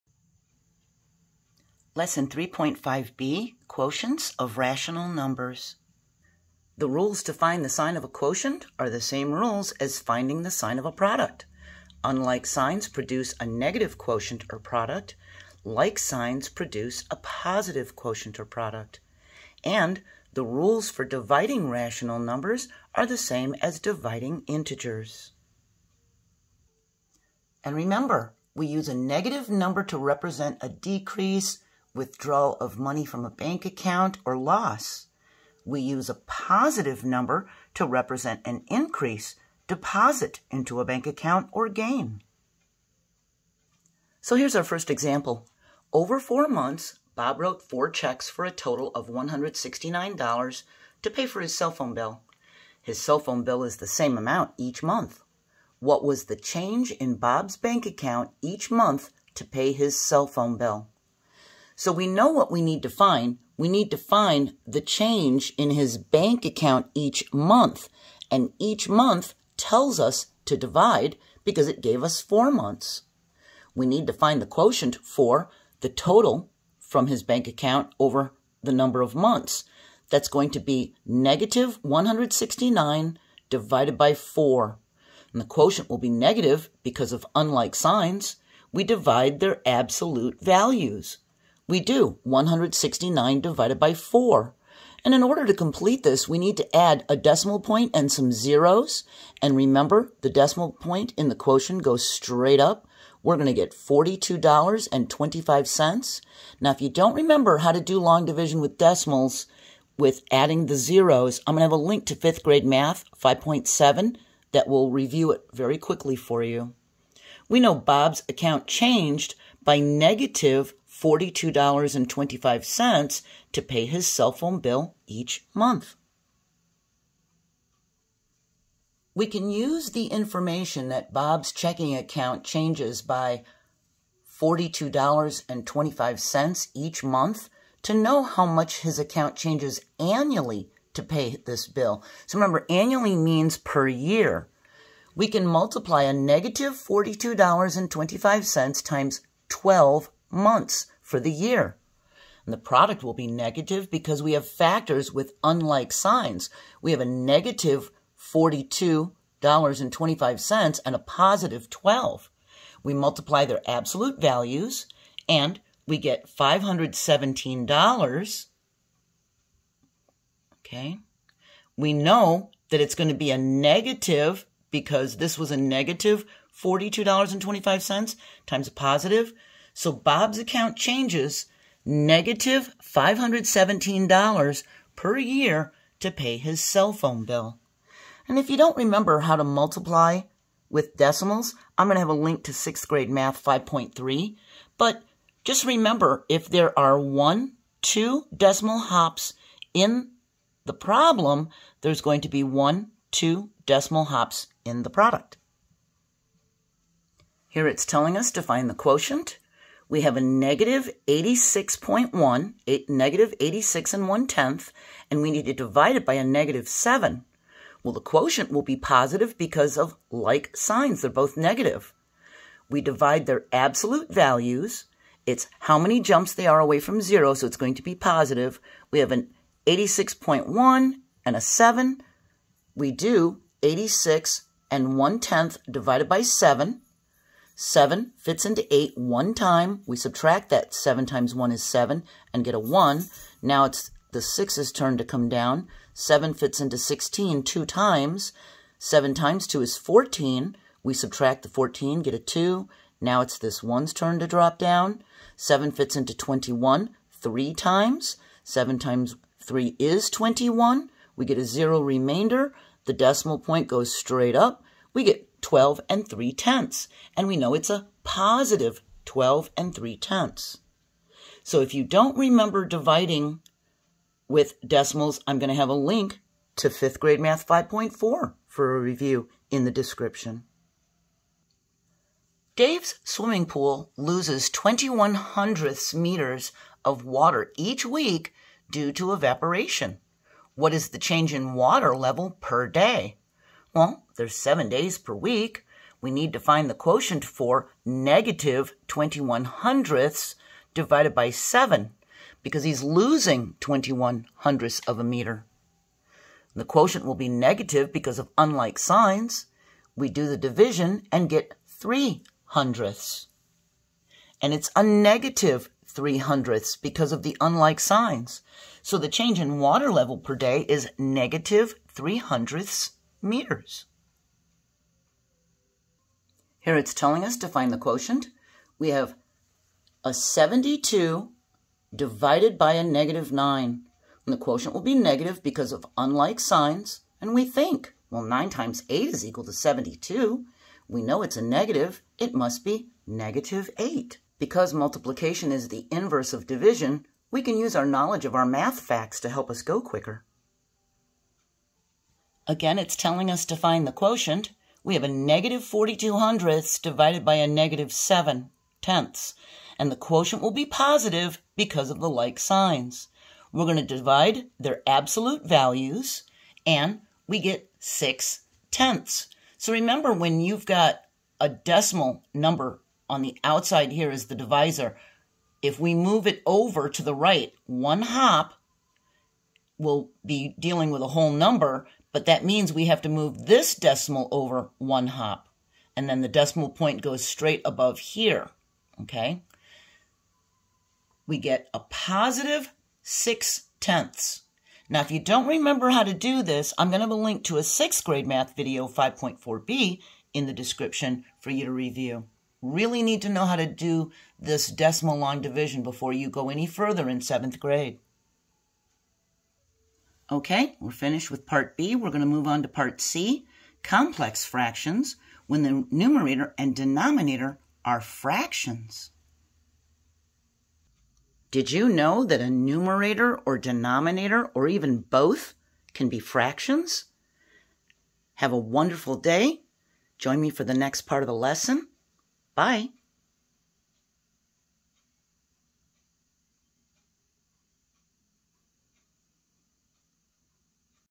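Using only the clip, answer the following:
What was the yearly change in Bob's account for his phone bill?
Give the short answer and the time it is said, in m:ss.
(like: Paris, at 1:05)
-$517, at 3:01.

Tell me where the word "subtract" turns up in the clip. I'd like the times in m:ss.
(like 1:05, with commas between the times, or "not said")
3:59, 4:10.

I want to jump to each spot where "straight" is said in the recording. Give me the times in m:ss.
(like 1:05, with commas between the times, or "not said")
1:42, 4:23, 6:27.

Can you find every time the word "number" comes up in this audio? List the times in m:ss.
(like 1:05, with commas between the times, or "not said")
0:05, 0:22, 0:29, 0:37, 1:18, 6:12, 6:21.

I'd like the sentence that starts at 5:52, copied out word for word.
Again, it's telling us to find the quotient.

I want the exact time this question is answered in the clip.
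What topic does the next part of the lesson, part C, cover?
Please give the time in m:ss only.
6:53.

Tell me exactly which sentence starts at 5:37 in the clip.
And we think, well, 9 times 8 is equal to 72.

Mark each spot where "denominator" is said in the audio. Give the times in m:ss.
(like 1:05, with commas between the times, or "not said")
6:56, 7:03.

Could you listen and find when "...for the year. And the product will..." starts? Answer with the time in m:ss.
2:31.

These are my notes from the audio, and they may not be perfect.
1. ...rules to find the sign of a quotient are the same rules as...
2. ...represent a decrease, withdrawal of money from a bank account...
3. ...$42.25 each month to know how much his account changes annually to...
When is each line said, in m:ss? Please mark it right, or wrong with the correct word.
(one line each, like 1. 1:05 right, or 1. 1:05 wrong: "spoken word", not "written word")
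1. 0:06 right
2. 0:29 right
3. 2:14 right.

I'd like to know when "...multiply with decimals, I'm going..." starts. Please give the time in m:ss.
3:09.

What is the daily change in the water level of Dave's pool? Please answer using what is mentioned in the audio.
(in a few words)
-0.03 meters.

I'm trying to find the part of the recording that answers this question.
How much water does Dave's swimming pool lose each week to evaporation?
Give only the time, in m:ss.
4:44.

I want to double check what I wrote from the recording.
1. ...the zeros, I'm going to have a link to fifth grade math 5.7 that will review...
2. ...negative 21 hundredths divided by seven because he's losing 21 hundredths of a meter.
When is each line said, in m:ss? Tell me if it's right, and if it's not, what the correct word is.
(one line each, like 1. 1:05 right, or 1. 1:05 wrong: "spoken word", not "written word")
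1. 1:50 right
2. 4:57 right.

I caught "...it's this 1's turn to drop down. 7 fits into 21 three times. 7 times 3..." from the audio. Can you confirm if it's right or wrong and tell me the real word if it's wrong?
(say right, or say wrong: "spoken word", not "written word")
right.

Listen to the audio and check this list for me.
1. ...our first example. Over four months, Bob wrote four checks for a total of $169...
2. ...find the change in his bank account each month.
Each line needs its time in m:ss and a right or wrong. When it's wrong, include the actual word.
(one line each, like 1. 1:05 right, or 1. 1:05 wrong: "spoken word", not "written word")
1. 0:44 right
2. 1:03 right.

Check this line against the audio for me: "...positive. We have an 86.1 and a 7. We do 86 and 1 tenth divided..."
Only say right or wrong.
right.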